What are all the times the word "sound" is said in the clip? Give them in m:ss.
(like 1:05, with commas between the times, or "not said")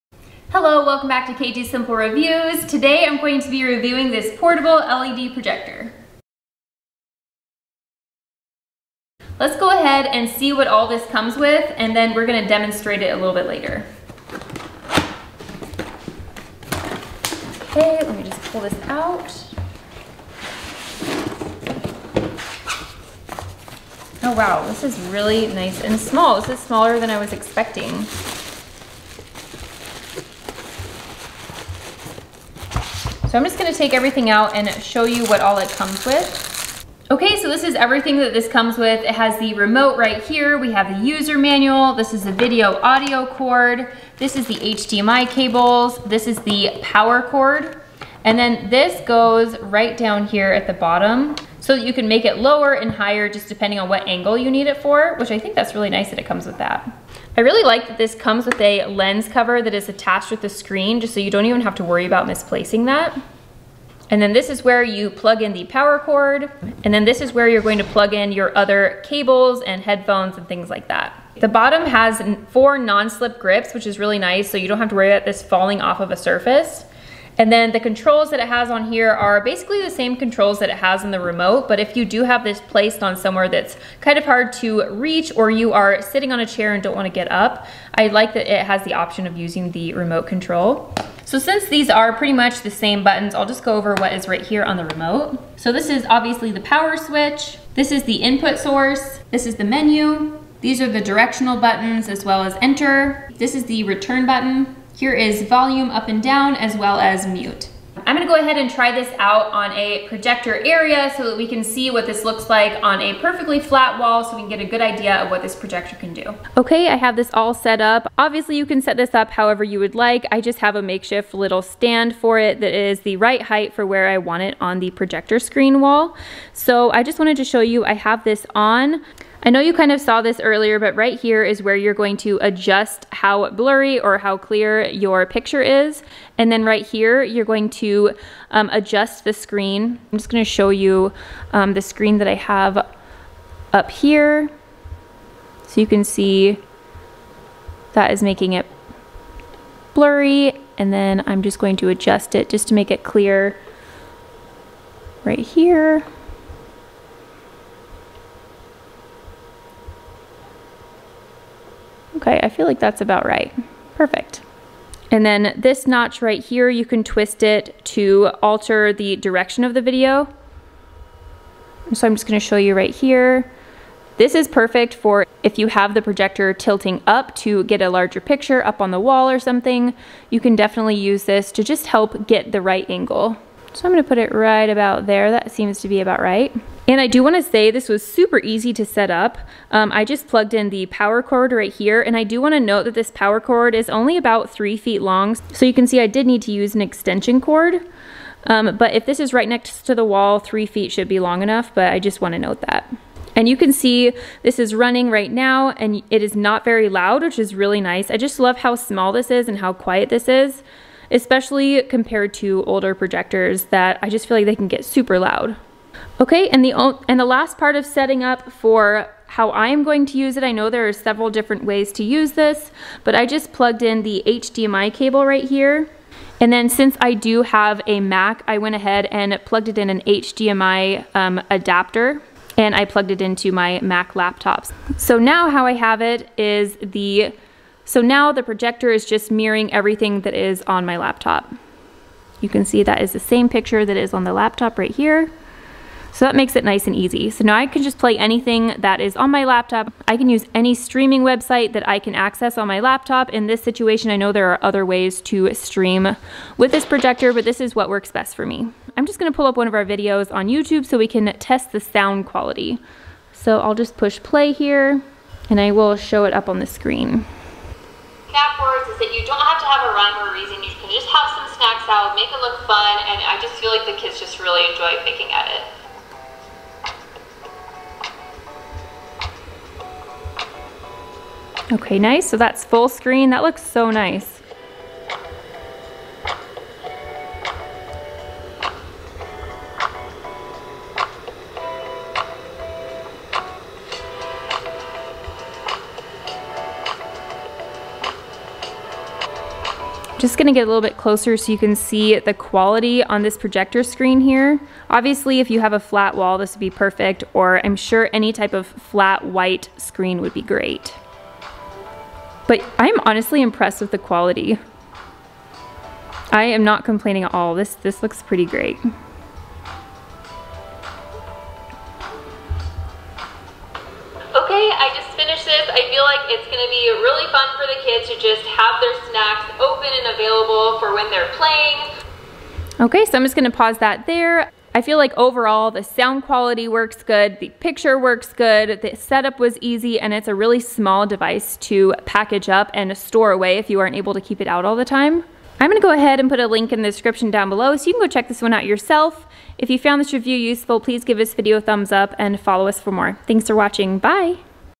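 4:21, 5:35.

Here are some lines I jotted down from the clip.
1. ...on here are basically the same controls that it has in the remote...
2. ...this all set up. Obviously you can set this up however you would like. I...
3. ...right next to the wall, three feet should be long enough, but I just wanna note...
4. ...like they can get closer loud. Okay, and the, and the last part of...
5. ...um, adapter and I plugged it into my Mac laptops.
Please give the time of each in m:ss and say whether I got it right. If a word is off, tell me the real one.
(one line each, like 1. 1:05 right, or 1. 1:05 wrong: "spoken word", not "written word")
1. 1:18 right
2. 1:57 right
3. 3:19 right
4. 3:34 wrong: "super", not "closer"
5. 3:51 right.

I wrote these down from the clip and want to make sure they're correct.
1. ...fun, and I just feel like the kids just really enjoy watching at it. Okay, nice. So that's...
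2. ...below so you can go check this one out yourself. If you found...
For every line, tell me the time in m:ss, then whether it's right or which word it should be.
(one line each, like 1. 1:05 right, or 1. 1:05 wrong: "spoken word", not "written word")
1. 4:32 wrong: "picking", not "watching"
2. 5:47 right.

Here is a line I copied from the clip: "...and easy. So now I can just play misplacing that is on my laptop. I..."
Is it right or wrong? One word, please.
wrong.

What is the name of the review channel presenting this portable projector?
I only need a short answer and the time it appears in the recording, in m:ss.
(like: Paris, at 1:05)
KG Simple Reviews, at 0:01.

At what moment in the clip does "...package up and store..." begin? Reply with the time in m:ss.
5:42.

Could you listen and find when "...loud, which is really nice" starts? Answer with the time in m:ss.
3:26.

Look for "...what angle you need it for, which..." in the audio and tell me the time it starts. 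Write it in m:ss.
0:53.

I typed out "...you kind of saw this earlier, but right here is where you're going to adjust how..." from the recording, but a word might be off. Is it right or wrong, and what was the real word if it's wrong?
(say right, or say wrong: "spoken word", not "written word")
right.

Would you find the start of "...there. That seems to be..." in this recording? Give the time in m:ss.
3:05.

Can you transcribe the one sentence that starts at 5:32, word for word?
Okay, so I'm just going to pause that there.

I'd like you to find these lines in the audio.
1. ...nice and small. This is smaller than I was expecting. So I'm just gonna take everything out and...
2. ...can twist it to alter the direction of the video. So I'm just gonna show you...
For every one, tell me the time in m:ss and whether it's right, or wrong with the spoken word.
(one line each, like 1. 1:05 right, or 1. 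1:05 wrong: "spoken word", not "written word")
1. 0:25 right
2. 2:46 right.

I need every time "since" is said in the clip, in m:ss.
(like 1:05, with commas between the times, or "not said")
1:31, 3:46.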